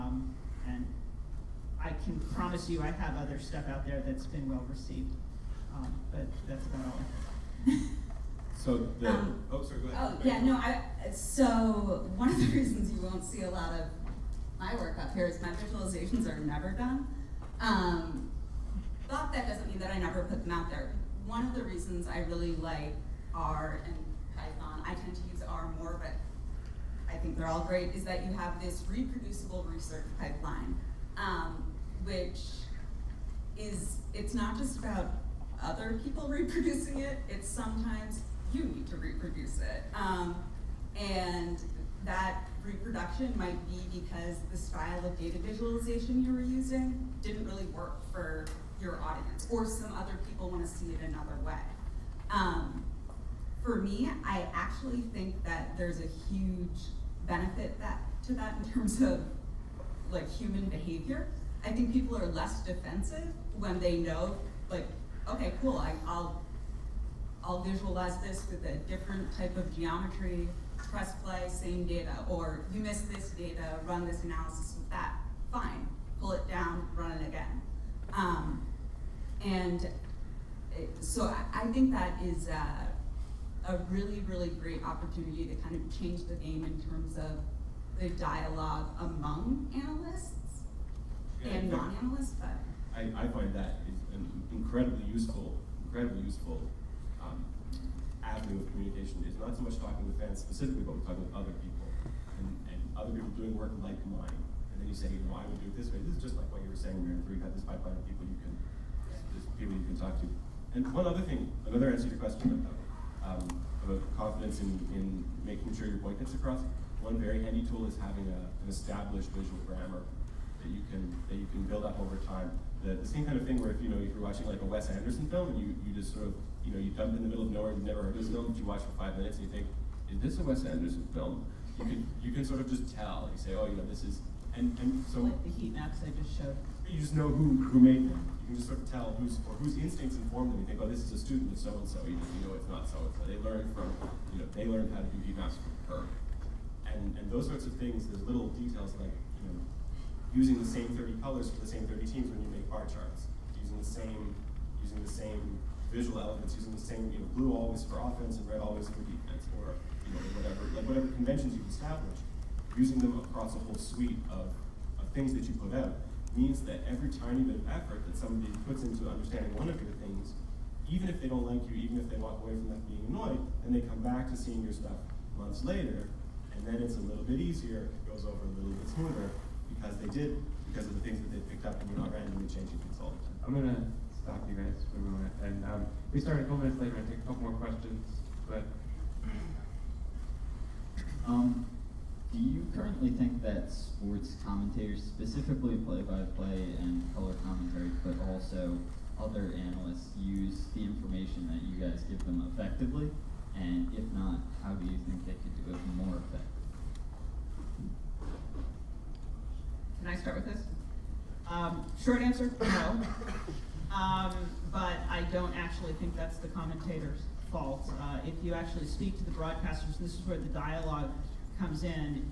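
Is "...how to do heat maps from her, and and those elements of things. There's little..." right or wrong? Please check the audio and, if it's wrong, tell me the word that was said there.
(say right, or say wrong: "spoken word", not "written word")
wrong: "sorts", not "elements".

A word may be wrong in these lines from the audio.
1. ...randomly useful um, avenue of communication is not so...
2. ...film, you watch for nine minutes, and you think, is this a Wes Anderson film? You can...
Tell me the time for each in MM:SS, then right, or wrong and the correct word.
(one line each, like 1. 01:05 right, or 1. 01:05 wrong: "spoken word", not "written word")
1. 01:35 wrong: "incredibly", not "randomly"
2. 02:08 wrong: "five", not "nine".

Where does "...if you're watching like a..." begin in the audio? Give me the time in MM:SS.
02:04.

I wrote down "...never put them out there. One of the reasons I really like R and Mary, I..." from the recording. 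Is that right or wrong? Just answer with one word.
wrong.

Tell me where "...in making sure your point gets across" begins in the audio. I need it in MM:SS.
01:54.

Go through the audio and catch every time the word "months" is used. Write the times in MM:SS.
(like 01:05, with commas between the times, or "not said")
02:55.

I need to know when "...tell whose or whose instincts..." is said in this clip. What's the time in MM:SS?
02:18.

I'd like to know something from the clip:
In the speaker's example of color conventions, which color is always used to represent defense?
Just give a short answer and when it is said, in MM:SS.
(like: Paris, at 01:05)
Red, at 02:38.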